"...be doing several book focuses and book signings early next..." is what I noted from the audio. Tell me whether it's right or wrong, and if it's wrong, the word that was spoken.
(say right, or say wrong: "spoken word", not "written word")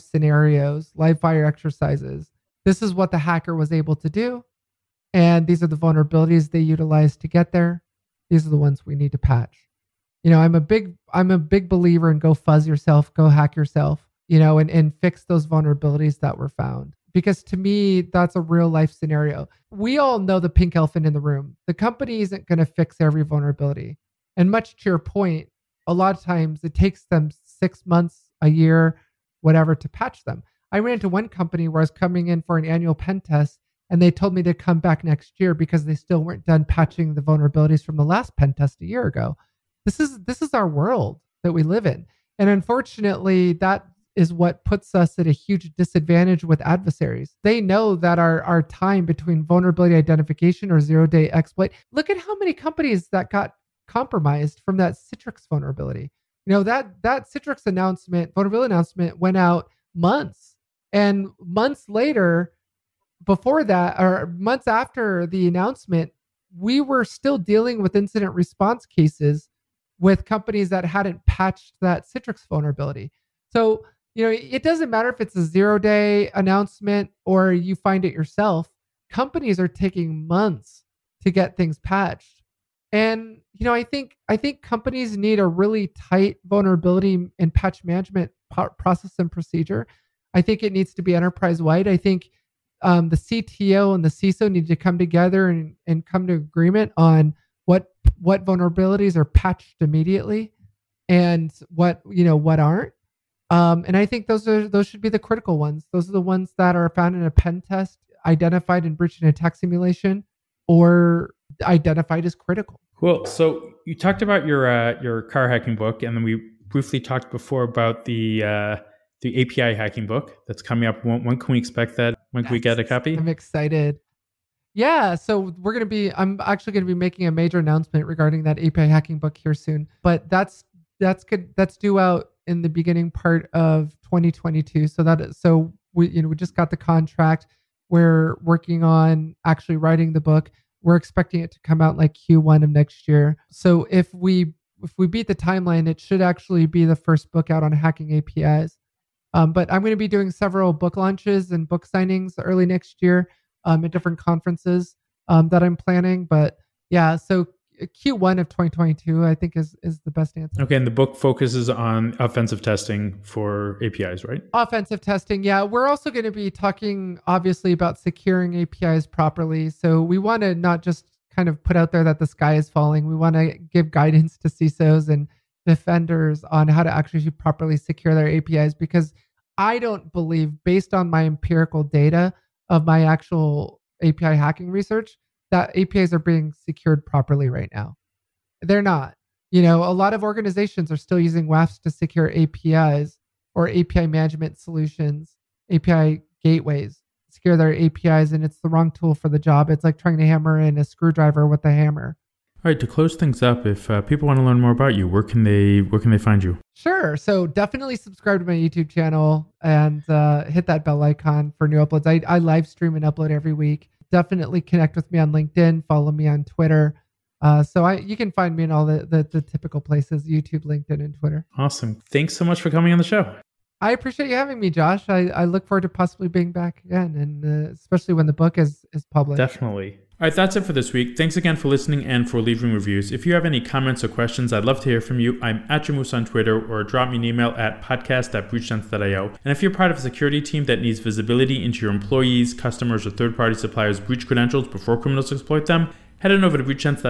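wrong: "launches", not "focuses".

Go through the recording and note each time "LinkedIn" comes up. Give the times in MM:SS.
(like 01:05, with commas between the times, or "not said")
03:35, 03:40.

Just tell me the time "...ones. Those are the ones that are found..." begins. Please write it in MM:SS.
01:45.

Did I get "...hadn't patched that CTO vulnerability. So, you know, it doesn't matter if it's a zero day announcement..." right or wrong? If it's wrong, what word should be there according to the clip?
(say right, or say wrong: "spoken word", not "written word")
wrong: "Citrix", not "CTO".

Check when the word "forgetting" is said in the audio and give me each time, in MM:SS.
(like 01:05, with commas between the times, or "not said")
not said.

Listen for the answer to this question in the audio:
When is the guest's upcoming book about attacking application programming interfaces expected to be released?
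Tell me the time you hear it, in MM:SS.
02:37.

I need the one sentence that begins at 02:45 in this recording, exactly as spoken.
We're also going to be talking obviously about securing APIs properly.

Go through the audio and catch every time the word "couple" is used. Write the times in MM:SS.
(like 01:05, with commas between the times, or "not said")
not said.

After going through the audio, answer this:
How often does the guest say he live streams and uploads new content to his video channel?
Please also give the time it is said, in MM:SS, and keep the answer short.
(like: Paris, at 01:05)
every week, at 03:33.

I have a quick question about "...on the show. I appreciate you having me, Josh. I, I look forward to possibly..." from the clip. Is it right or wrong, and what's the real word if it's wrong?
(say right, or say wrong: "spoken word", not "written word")
right.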